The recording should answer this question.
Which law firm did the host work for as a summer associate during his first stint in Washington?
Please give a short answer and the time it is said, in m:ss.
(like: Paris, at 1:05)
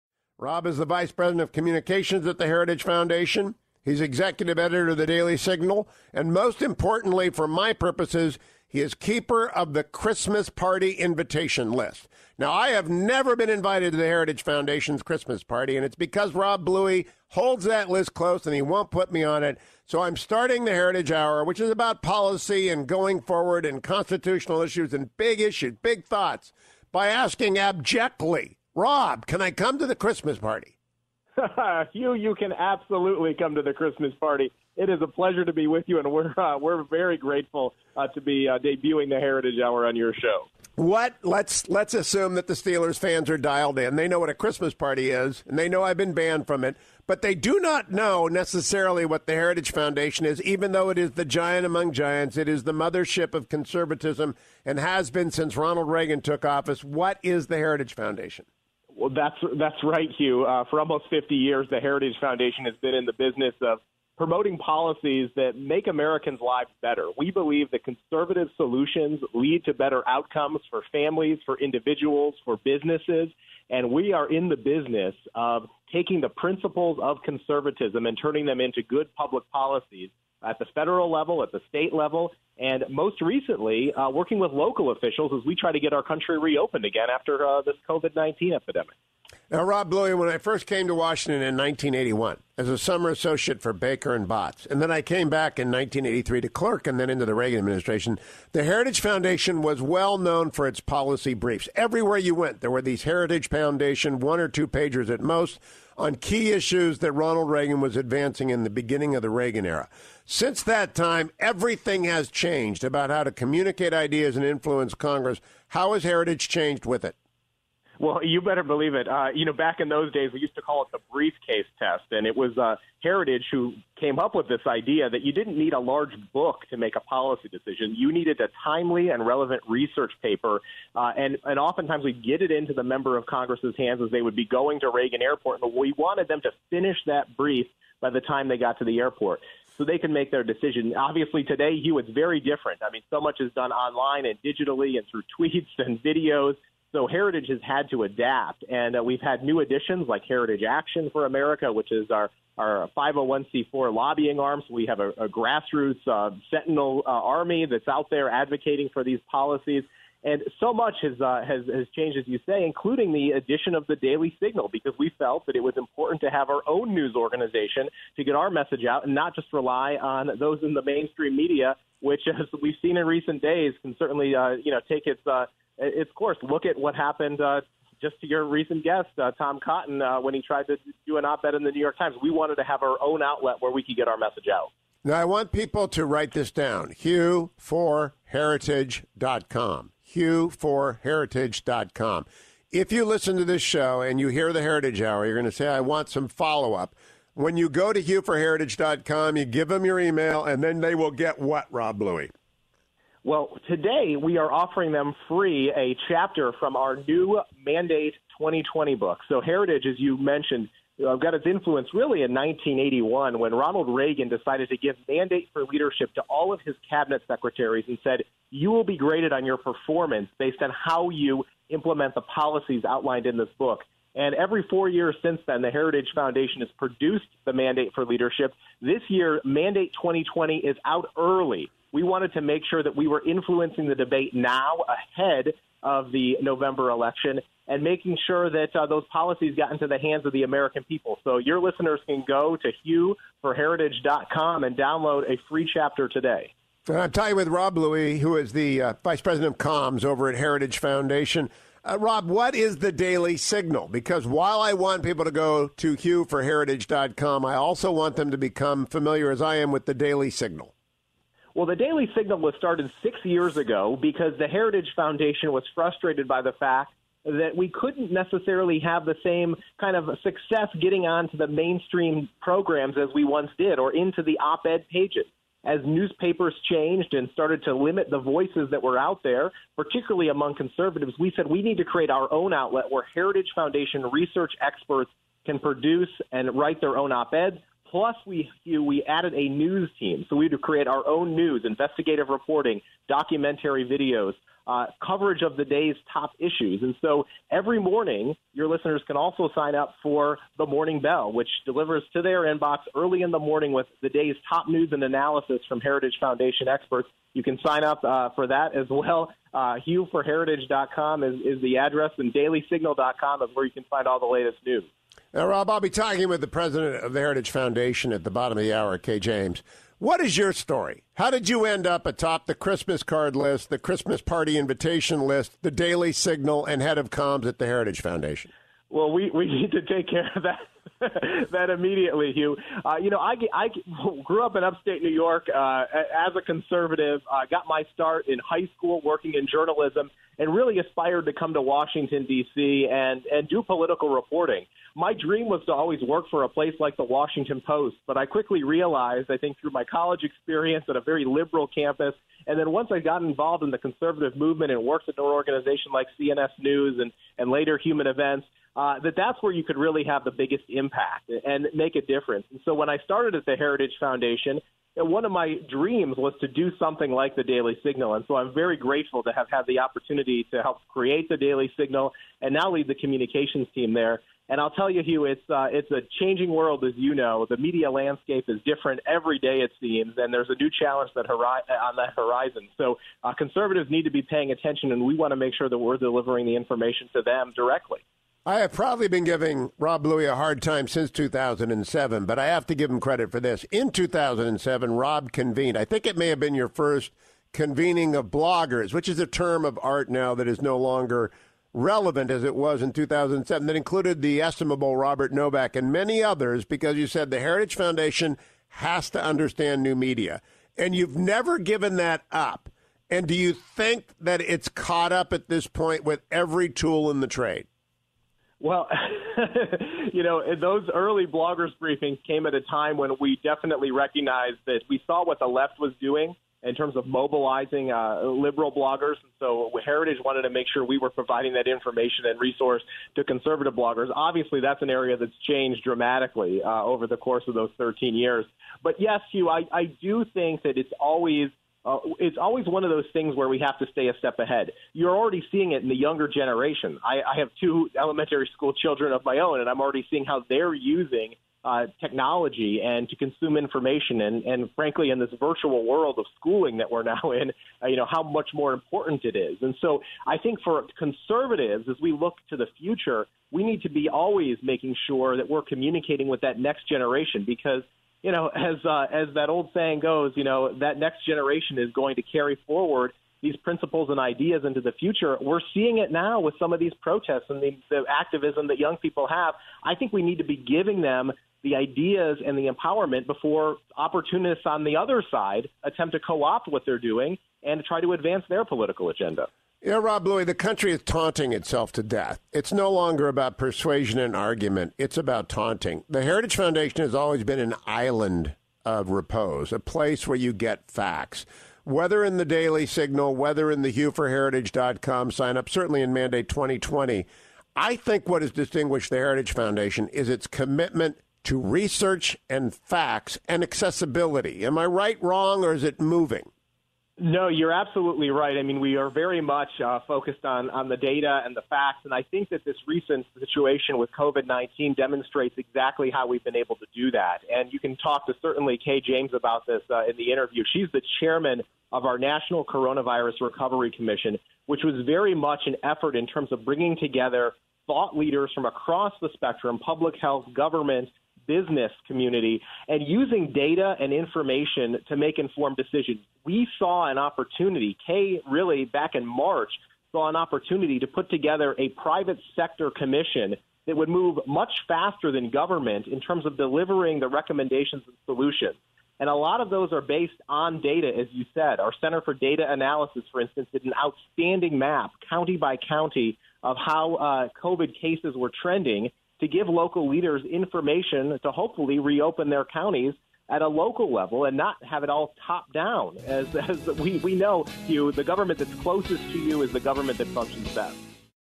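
Baker and Botts, at 1:33.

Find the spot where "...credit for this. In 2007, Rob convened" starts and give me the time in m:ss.
6:32.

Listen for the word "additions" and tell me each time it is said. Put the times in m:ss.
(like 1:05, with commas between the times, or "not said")
2:29, 2:43.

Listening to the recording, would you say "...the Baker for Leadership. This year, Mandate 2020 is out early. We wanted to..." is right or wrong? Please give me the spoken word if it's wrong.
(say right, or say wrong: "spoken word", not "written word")
wrong: "Mandate", not "Baker".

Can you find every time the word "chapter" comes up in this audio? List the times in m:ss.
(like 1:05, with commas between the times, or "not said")
3:26, 4:05.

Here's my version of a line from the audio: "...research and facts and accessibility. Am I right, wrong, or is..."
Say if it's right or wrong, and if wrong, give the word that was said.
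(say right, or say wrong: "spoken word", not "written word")
right.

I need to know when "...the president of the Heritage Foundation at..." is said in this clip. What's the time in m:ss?
5:16.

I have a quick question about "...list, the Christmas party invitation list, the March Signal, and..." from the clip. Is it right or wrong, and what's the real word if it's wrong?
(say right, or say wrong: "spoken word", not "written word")
wrong: "Daily", not "March".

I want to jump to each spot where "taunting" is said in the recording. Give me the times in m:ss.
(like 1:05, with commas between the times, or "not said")
8:11, 8:15.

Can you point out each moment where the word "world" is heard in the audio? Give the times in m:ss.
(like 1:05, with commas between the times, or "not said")
6:16, 7:35.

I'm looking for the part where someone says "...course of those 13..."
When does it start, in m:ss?
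7:17.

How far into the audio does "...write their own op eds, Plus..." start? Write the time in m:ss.
4:46.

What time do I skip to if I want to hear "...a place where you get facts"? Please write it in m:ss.
8:19.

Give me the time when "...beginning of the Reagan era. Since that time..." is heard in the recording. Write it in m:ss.
1:48.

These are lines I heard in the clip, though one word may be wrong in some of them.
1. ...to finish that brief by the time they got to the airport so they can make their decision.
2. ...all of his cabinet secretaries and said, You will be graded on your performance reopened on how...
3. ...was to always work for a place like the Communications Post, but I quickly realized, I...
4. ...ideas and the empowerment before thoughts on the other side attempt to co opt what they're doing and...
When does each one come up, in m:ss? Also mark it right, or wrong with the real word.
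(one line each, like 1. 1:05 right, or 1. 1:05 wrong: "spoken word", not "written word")
1. 2:16 right
2. 3:36 wrong: "based", not "reopened"
3. 5:45 wrong: "Washington", not "Communications"
4. 8:01 wrong: "opportunists", not "thoughts".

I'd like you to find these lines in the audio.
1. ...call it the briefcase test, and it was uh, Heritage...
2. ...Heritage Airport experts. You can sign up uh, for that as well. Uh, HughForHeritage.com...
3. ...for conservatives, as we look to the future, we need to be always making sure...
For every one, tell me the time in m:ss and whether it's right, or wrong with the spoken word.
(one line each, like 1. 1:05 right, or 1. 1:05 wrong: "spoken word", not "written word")
1. 2:00 right
2. 5:05 wrong: "Foundation", not "Airport"
3. 7:40 right.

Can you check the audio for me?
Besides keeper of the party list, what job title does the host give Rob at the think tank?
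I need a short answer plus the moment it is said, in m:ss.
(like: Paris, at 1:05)
Vice President of Communications, at 0:00.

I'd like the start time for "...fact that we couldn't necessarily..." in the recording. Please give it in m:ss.
4:26.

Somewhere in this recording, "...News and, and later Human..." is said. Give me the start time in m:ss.
5:56.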